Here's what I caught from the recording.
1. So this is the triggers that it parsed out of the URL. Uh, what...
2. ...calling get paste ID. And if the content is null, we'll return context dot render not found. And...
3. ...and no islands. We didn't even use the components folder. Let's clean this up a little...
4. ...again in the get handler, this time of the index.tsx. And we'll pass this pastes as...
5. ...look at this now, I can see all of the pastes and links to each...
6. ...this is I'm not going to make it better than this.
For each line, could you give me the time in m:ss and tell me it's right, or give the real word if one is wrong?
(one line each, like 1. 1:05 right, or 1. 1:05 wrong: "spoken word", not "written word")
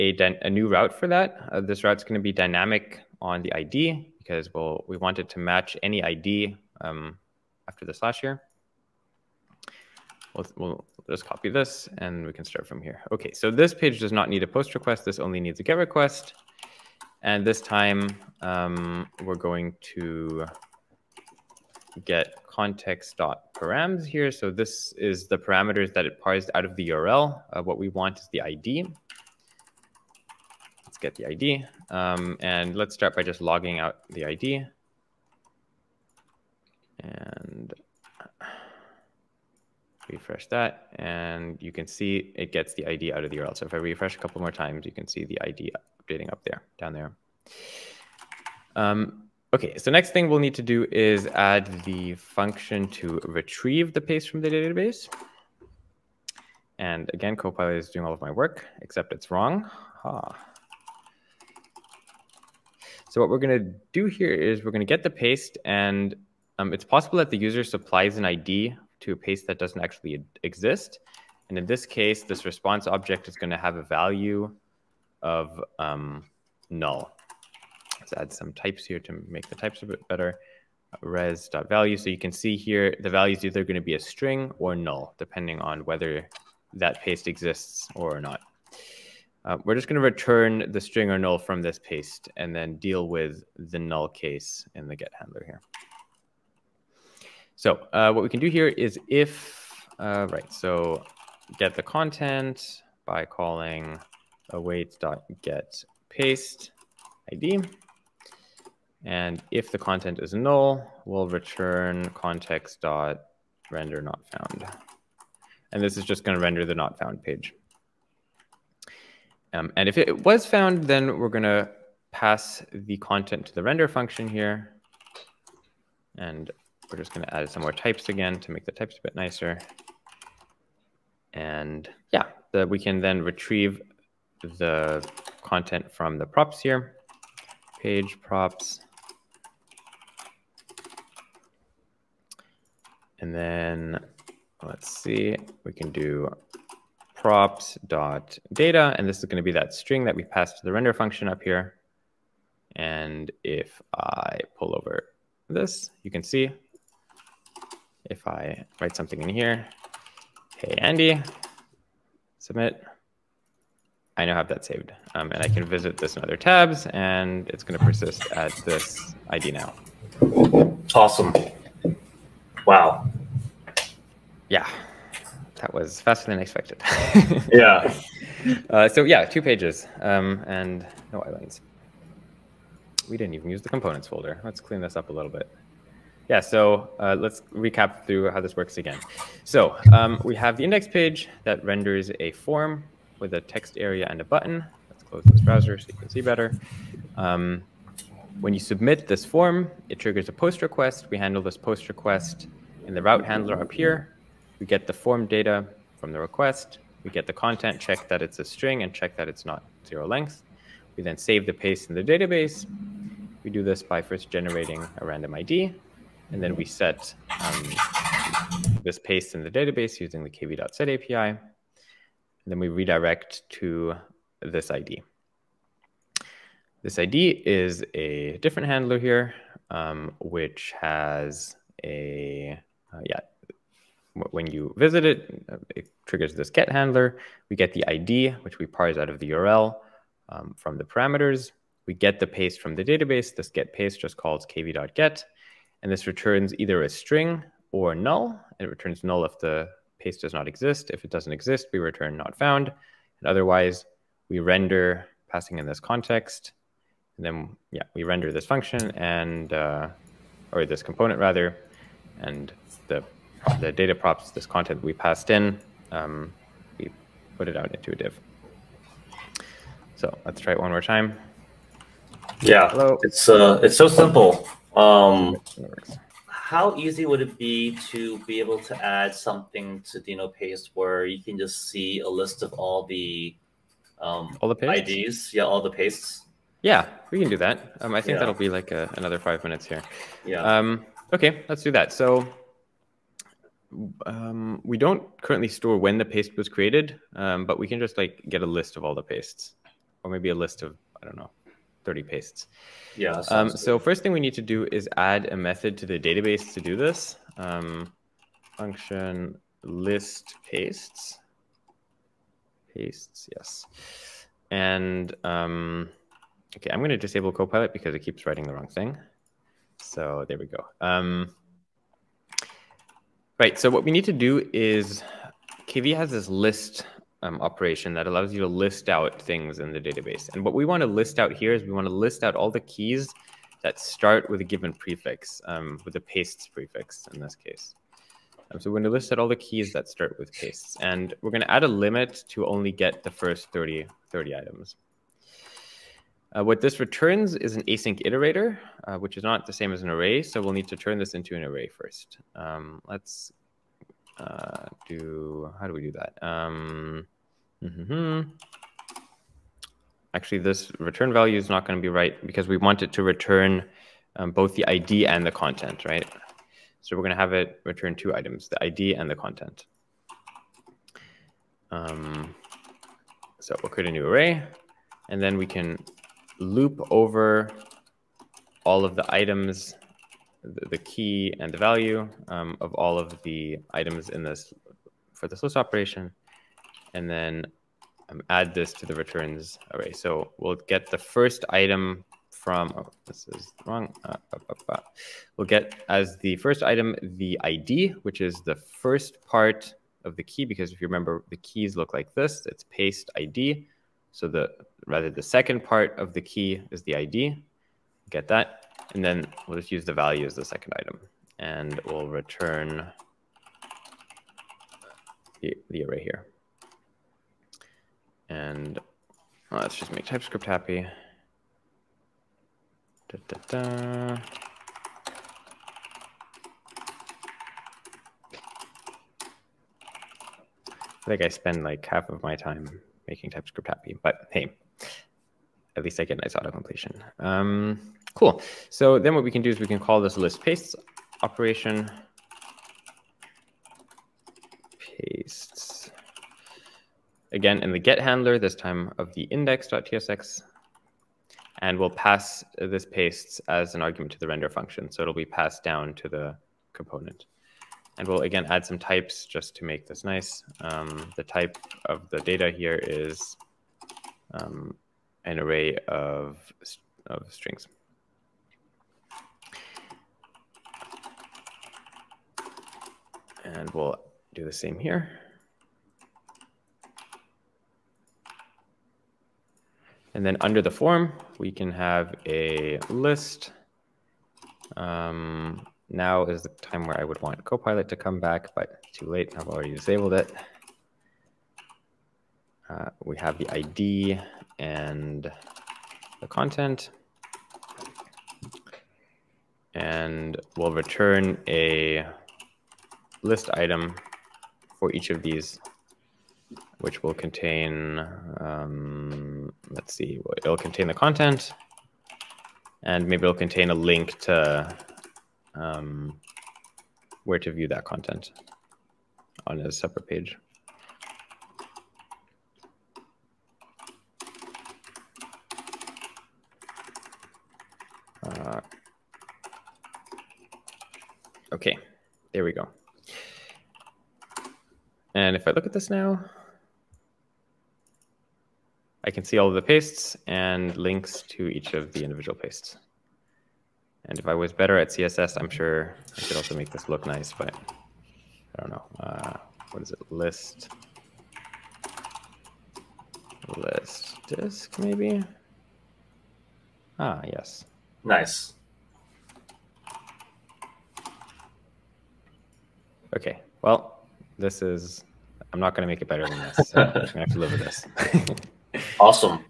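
1. 0:24 wrong: "parameters", not "triggers"
2. 1:43 right
3. 3:00 right
4. 7:27 right
5. 8:55 right
6. 9:24 right.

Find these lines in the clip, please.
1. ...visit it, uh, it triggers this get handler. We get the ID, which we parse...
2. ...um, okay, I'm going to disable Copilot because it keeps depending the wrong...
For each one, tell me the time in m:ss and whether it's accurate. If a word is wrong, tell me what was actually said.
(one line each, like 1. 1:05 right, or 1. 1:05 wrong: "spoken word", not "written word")
1. 3:54 right
2. 5:15 wrong: "writing", not "depending".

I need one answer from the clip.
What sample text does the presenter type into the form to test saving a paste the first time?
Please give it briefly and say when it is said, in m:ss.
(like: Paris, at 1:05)
hey, Andy, at 2:40.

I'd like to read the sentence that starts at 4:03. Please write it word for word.
This get paste just calls kv.get.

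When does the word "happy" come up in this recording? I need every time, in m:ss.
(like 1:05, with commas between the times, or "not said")
7:00, 7:13.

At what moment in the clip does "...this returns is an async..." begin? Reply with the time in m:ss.
5:46.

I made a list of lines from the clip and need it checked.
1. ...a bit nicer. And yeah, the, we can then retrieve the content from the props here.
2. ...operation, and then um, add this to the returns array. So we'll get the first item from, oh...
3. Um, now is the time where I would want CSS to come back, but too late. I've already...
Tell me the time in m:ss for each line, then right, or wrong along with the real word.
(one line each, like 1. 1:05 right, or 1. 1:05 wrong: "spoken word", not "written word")
1. 2:08 right
2. 6:25 right
3. 8:04 wrong: "Copilot", not "CSS".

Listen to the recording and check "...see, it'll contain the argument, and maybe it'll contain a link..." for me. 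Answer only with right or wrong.
wrong.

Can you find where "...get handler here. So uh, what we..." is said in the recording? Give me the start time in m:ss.
1:34.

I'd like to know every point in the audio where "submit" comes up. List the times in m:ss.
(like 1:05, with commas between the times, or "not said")
2:42, 3:18.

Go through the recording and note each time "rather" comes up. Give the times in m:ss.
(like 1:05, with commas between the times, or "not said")
4:21, 6:44.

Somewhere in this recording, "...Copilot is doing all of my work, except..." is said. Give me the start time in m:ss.
0:57.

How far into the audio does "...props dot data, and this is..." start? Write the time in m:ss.
2:27.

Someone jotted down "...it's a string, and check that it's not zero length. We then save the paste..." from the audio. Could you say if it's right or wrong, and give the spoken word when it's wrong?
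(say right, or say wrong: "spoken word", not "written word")
right.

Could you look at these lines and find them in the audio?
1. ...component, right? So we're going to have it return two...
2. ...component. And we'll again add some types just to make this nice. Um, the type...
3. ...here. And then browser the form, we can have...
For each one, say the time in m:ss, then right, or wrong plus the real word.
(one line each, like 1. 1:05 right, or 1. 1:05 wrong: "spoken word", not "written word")
1. 6:05 wrong: "content", not "component"
2. 7:36 right
3. 7:54 wrong: "under", not "browser".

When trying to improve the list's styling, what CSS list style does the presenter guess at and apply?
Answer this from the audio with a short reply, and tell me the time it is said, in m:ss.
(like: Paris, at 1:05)
list disc, at 9:13.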